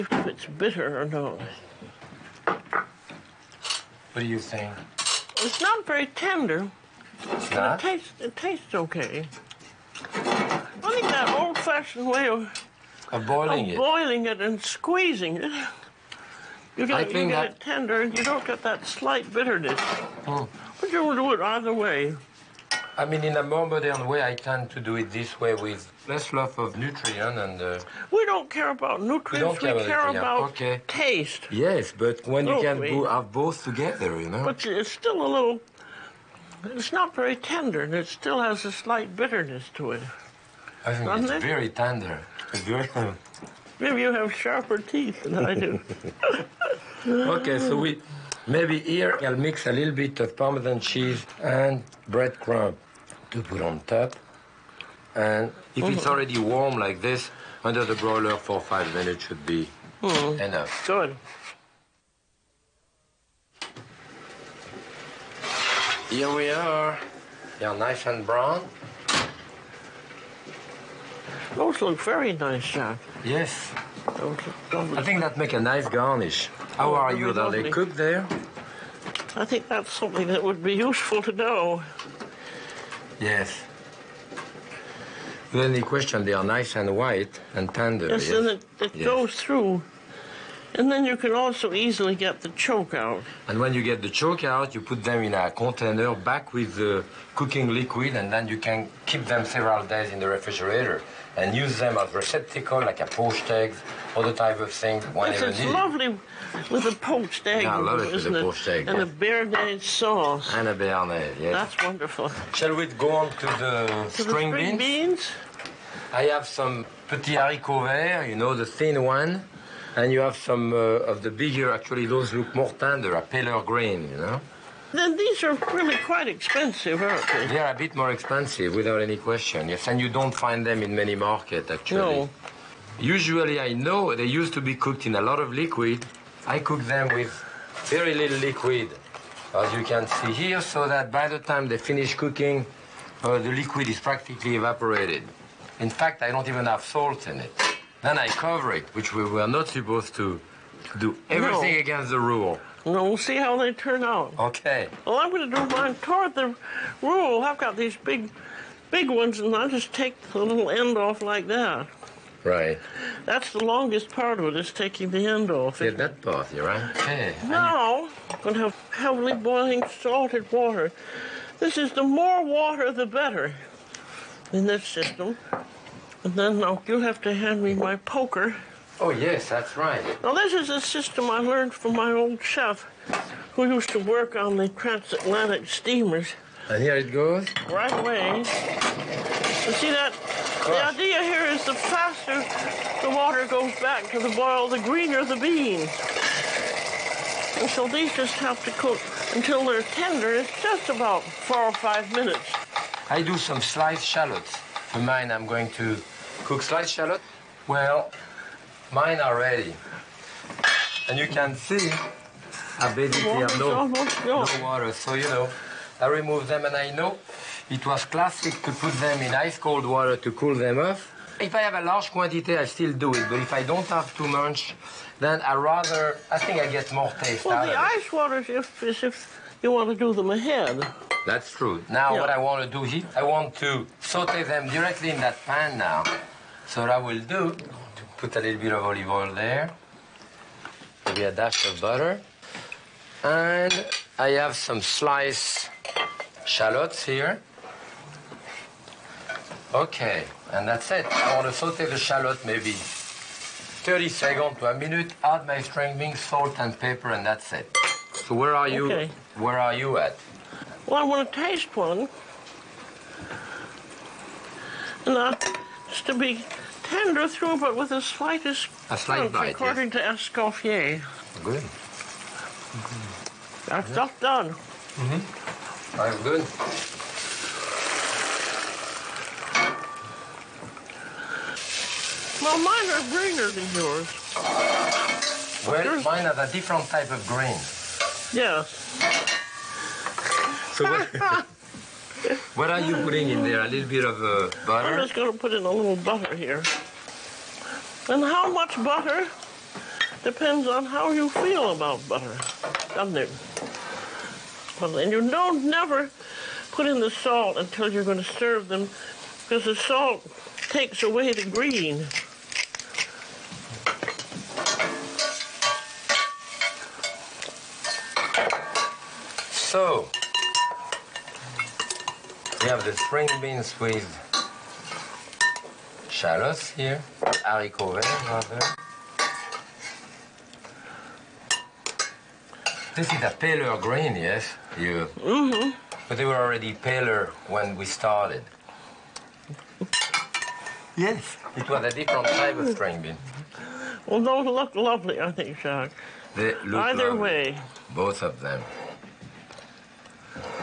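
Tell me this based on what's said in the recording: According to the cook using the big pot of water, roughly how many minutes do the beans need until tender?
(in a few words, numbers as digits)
4 or 5 minutes.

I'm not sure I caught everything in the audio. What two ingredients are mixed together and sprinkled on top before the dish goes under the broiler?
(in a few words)
Parmesan cheese and breadcrumb.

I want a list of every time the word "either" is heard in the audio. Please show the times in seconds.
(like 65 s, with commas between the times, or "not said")
21 s, 346 s.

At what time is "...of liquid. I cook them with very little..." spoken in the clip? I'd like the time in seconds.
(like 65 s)
135 s.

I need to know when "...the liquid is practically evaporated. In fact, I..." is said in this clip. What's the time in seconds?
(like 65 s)
143 s.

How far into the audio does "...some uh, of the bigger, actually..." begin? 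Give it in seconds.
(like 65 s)
120 s.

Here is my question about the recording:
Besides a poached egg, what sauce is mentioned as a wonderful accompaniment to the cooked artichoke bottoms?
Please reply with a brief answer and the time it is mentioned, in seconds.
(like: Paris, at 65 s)
Béarnaise sauce, at 109 s.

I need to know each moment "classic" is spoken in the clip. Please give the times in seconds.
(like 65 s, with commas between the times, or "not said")
218 s.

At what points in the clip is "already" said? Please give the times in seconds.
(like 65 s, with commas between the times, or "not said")
56 s, 336 s.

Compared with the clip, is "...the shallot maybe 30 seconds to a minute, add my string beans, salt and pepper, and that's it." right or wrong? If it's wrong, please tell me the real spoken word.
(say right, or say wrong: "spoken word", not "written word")
right.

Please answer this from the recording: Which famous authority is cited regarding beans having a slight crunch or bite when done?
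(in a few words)
Escoffier.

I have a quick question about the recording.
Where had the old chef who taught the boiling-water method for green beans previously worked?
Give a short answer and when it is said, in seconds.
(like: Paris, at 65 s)
Transatlantic steamers, at 184 s.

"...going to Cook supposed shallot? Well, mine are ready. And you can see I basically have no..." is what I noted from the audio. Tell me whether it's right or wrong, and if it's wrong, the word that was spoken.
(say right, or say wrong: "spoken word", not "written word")
wrong: "sliced", not "supposed".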